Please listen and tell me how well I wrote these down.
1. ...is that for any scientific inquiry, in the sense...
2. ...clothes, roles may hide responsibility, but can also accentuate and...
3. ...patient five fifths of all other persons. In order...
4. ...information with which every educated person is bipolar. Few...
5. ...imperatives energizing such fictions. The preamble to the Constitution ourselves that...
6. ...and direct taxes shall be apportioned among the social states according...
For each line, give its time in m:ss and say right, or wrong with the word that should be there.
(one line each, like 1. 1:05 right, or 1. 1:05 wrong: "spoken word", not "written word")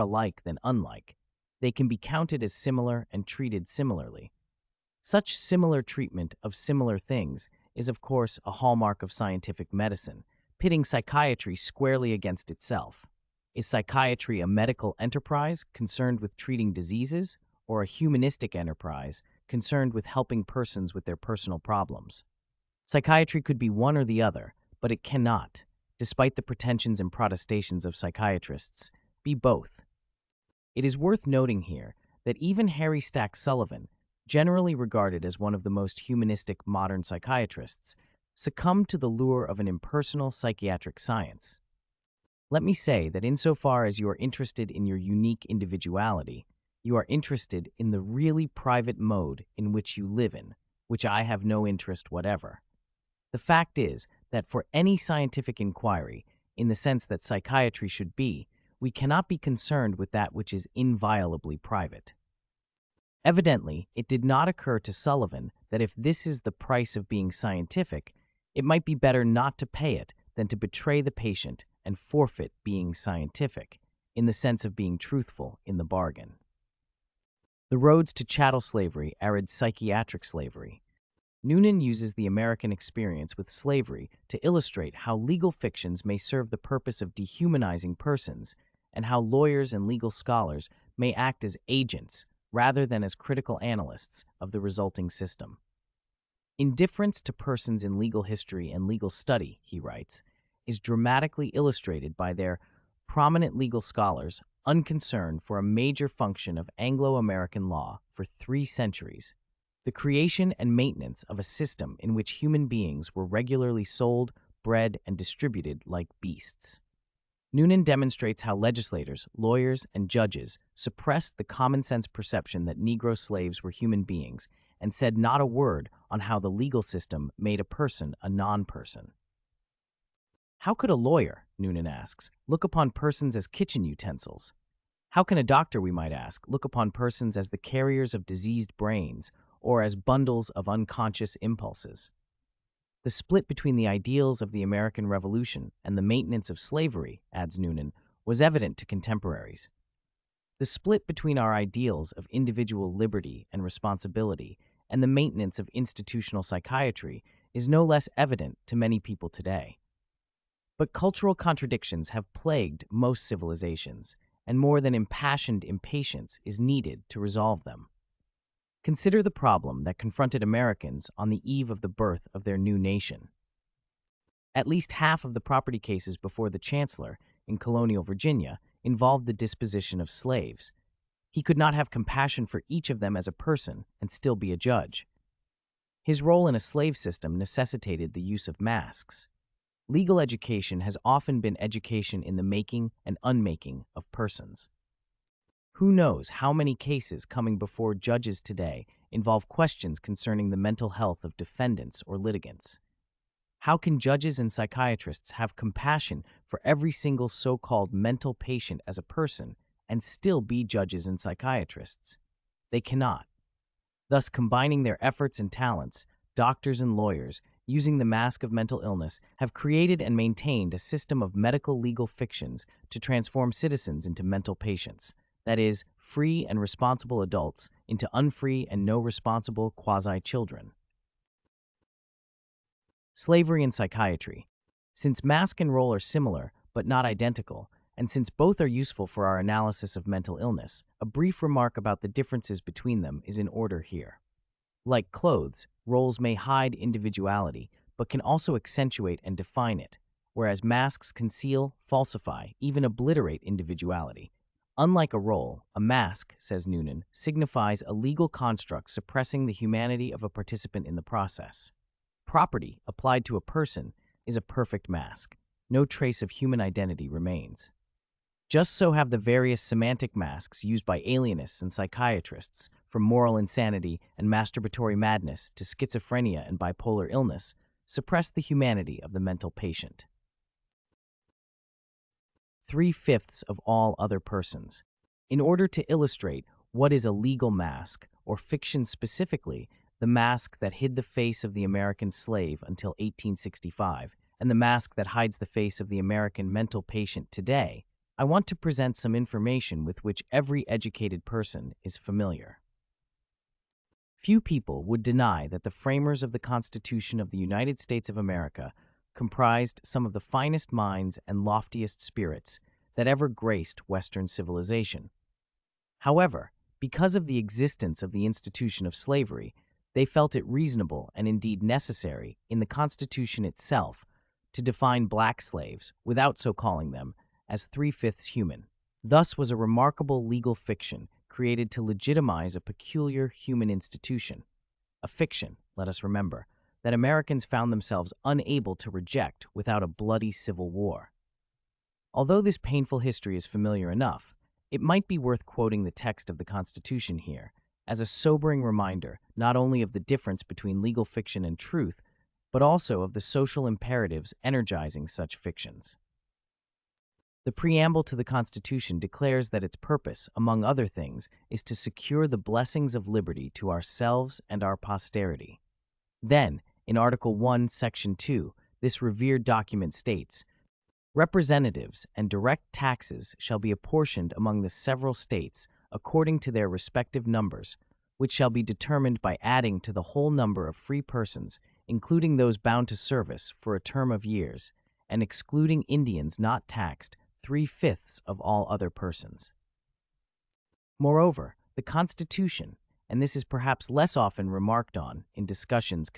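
1. 0:53 right
2. 4:05 wrong: "individuality", not "responsibility"
3. 4:39 wrong: "three", not "five"
4. 4:59 wrong: "familiar", not "bipolar"
5. 5:53 wrong: "declares", not "ourselves"
6. 6:12 wrong: "several", not "social".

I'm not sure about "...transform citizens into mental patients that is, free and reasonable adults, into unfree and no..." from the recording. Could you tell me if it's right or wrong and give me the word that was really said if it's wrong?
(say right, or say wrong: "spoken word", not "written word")
wrong: "responsible", not "reasonable".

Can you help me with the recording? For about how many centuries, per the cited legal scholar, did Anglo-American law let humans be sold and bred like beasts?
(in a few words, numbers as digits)
3.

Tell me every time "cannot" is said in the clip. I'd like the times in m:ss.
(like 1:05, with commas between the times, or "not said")
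0:25, 0:58, 3:32.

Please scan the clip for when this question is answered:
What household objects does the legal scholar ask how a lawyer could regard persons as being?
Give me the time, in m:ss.
2:13.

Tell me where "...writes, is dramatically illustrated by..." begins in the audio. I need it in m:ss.
1:39.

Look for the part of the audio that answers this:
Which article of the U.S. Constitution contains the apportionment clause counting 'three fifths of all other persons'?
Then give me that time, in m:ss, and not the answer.
6:06.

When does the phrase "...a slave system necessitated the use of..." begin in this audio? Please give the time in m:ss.
3:06.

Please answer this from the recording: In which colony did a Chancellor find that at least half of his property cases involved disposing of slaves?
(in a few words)
Virginia.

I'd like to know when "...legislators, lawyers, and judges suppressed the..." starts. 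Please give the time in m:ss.
1:58.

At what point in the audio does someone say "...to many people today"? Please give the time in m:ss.
2:38.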